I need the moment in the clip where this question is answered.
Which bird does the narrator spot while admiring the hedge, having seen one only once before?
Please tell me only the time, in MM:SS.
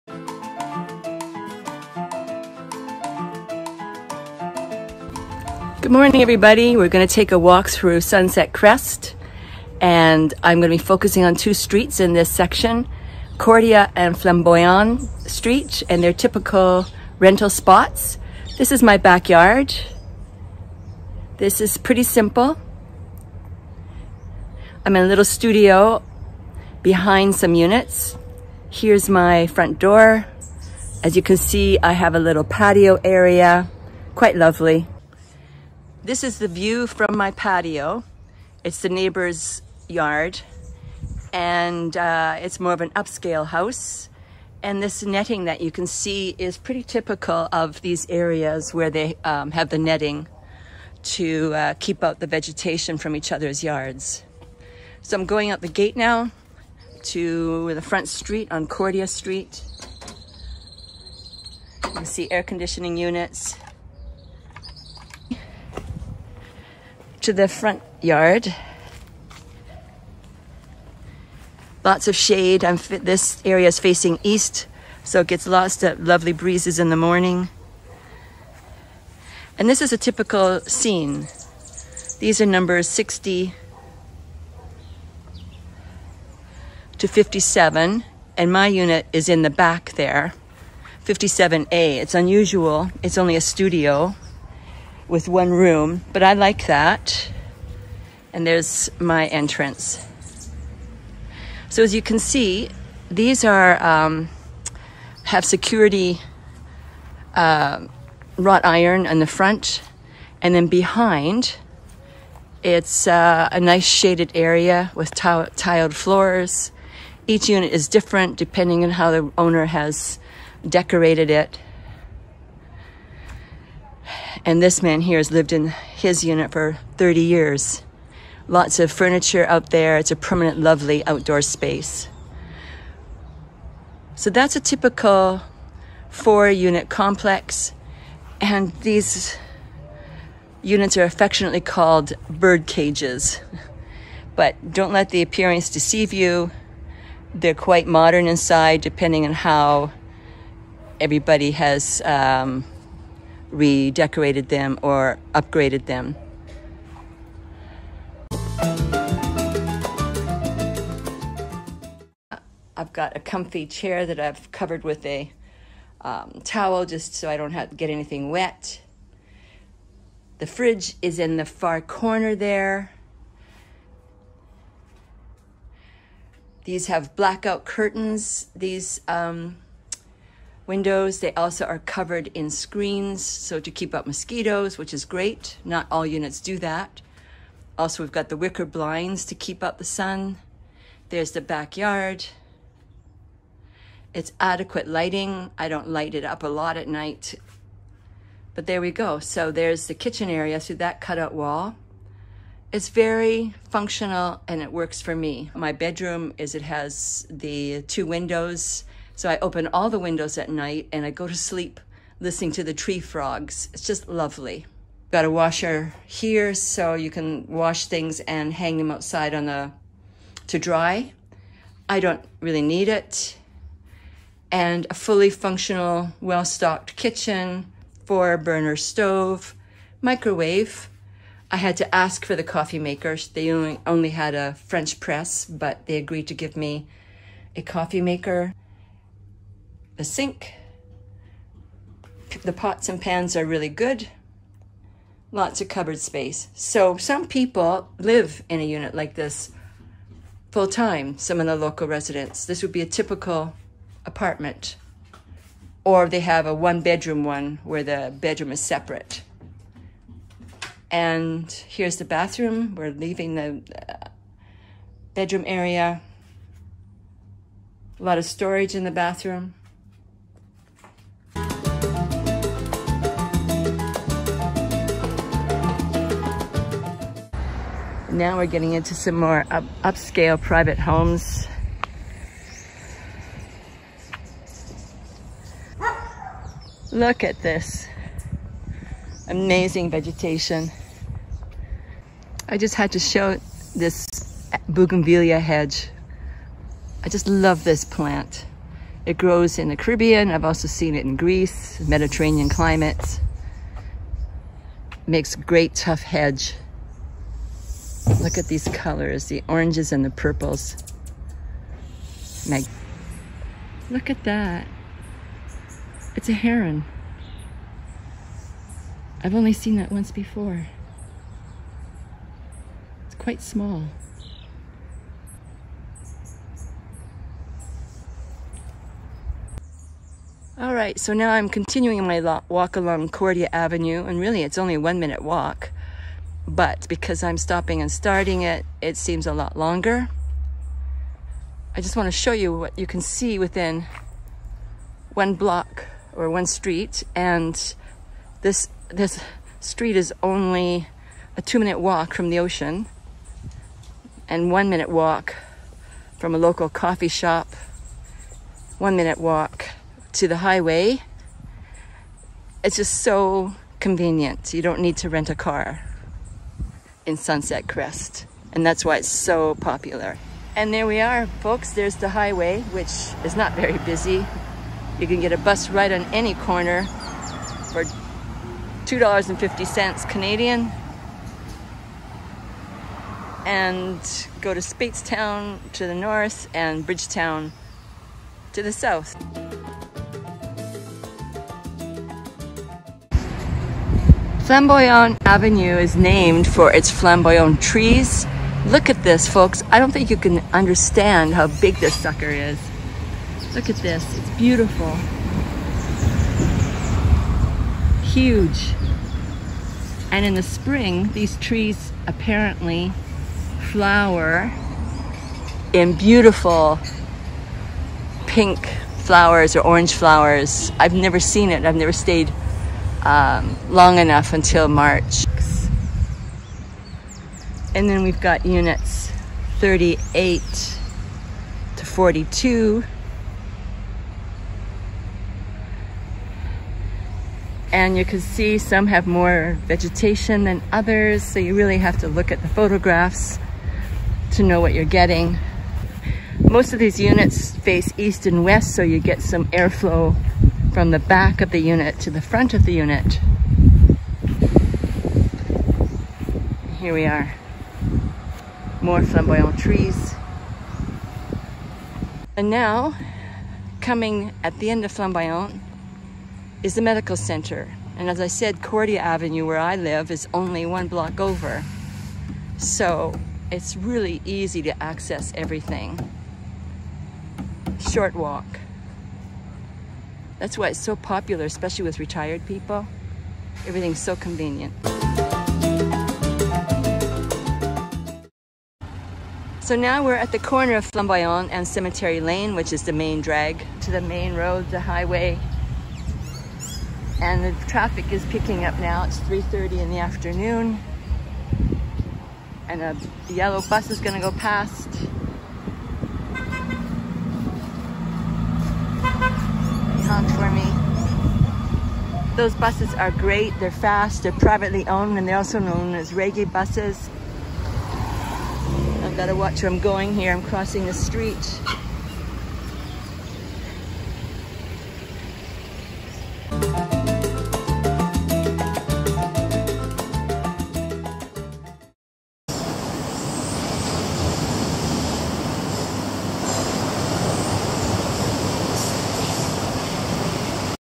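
05:16.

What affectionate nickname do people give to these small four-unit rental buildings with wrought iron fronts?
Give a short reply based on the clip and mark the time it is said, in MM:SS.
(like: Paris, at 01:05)
bird cages, at 02:22.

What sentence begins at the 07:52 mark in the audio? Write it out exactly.
So it's really easy to access everything.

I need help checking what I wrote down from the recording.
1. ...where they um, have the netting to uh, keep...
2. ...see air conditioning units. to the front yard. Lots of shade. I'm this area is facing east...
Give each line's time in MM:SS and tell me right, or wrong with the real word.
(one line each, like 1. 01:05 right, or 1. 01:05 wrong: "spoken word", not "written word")
1. 00:48 right
2. 01:02 right.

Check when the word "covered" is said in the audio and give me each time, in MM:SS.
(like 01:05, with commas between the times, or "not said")
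02:44, 03:01.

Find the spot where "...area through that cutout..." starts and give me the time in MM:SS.
03:20.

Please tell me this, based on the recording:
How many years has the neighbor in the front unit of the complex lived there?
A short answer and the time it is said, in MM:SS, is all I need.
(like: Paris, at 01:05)
30 years, at 02:06.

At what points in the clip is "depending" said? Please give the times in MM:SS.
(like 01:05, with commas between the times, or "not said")
01:58, 02:28.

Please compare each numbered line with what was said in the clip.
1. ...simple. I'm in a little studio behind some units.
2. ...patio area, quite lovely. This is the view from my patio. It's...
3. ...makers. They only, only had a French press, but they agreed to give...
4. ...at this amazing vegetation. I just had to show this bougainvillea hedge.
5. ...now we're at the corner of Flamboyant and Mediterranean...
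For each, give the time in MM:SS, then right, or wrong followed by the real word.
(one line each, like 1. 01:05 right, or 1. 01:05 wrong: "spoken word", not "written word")
1. 00:22 right
2. 00:32 right
3. 03:52 right
4. 04:47 right
5. 08:09 wrong: "Cemetery", not "Mediterranean".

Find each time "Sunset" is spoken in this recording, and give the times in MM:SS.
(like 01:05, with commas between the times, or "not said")
00:08, 06:07.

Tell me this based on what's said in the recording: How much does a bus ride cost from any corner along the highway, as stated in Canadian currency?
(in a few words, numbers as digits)
$2.50.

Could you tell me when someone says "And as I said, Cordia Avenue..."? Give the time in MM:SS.
07:47.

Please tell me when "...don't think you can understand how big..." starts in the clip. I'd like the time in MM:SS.
06:39.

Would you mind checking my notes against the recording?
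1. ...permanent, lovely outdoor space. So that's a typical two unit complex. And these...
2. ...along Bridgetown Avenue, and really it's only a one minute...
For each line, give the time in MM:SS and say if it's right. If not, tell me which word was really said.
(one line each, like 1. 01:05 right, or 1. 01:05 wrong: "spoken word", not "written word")
1. 02:10 wrong: "four", not "two"
2. 05:32 wrong: "Cordia", not "Bridgetown".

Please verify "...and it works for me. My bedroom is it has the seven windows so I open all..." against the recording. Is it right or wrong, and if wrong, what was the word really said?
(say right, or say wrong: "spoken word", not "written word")
wrong: "two", not "seven".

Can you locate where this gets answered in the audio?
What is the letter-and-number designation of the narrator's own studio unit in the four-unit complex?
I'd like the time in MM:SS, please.
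01:31.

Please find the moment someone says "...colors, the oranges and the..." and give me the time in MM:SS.
05:08.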